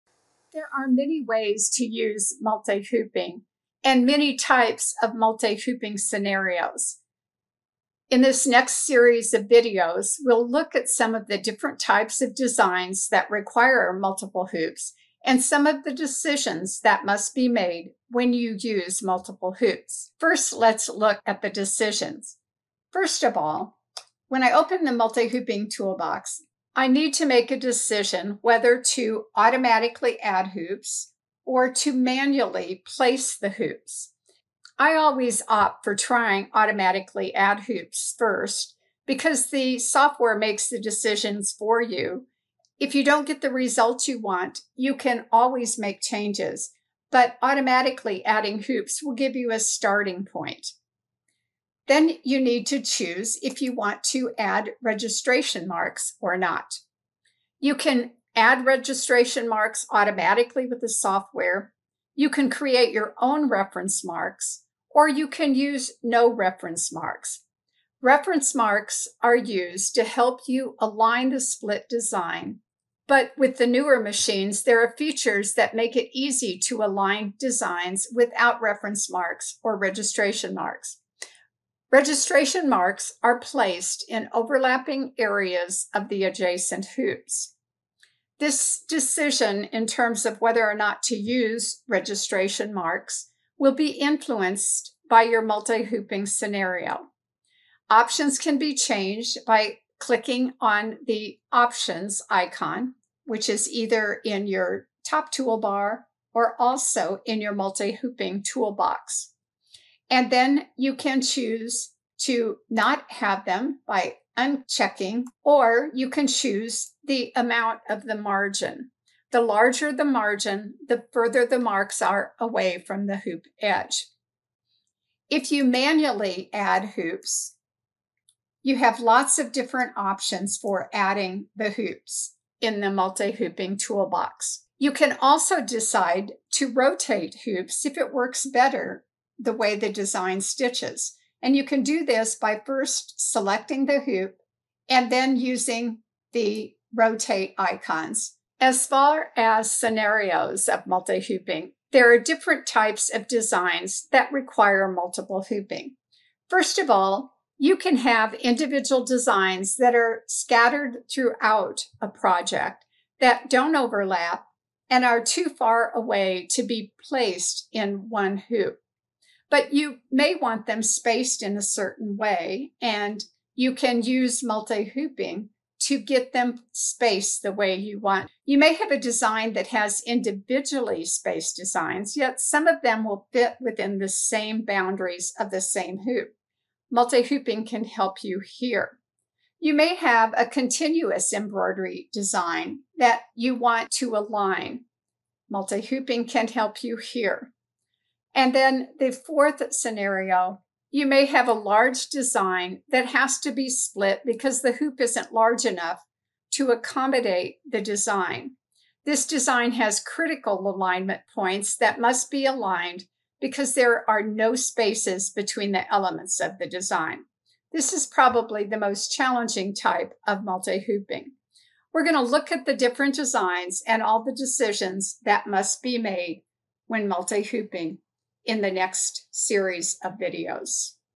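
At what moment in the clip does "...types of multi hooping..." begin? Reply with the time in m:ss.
0:04.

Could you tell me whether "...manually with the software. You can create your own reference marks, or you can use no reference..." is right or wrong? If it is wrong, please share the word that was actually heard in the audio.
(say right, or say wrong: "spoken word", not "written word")
wrong: "automatically", not "manually".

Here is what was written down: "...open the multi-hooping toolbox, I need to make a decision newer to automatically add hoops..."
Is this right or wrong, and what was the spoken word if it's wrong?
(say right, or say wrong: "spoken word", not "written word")
wrong: "whether", not "newer".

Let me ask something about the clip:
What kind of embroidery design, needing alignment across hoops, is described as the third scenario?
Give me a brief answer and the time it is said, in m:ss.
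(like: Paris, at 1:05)
Continuous embroidery design, at 3:10.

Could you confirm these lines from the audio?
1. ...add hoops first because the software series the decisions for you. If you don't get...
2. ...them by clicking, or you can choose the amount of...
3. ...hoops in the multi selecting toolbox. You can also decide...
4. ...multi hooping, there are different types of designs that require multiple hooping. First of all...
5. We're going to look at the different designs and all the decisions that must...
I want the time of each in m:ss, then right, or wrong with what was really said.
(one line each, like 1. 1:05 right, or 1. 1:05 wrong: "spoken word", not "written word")
1. 0:37 wrong: "makes", not "series"
2. 1:53 wrong: "unchecking", not "clicking"
3. 2:11 wrong: "hooping", not "selecting"
4. 2:30 right
5. 3:41 right.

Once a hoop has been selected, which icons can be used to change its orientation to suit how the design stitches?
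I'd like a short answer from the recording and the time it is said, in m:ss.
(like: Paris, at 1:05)
Rotate icons, at 2:26.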